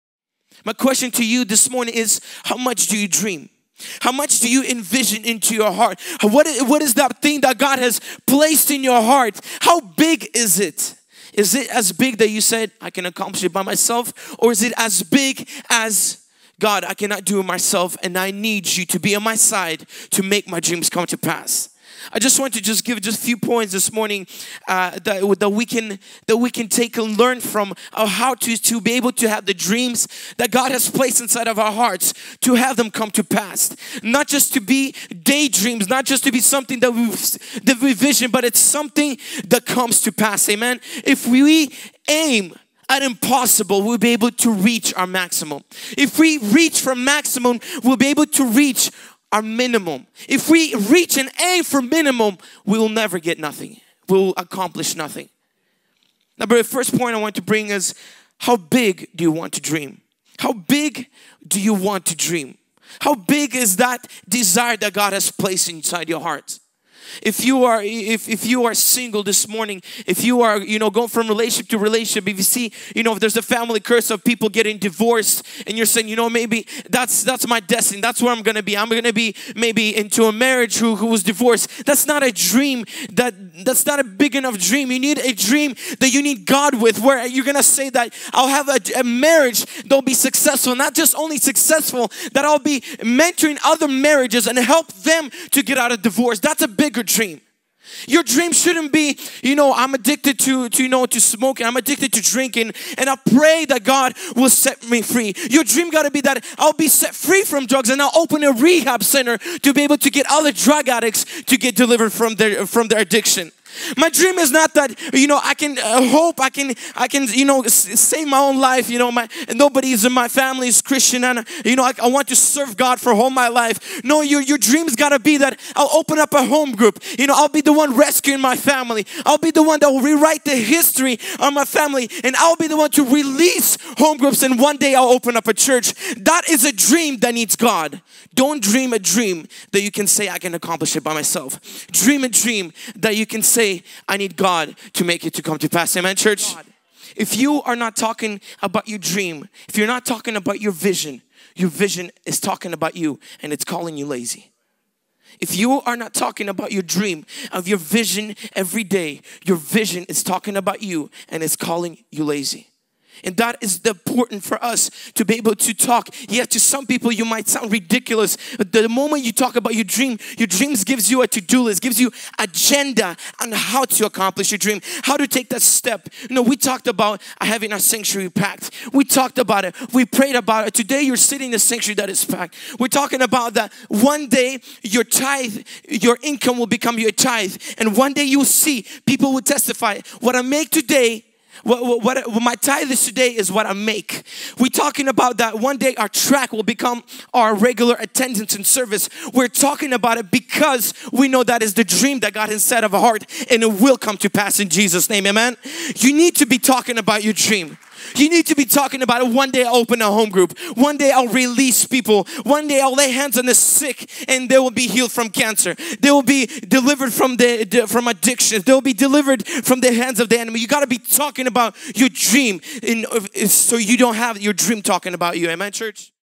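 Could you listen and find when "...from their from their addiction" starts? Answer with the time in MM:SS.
01:52.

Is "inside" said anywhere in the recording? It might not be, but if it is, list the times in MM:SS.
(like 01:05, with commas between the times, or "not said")
00:31, 01:05.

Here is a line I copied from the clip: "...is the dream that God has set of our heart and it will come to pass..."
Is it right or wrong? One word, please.
right.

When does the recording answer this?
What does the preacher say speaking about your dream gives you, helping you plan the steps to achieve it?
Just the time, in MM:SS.
02:51.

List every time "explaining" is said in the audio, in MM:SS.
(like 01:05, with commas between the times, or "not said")
not said.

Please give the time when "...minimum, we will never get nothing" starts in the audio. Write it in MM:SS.
00:51.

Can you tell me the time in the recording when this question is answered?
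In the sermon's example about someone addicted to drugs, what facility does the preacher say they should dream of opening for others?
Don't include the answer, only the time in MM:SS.
01:48.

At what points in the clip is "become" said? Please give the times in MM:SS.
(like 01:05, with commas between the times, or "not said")
03:06, 03:16.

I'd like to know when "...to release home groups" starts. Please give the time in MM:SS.
02:12.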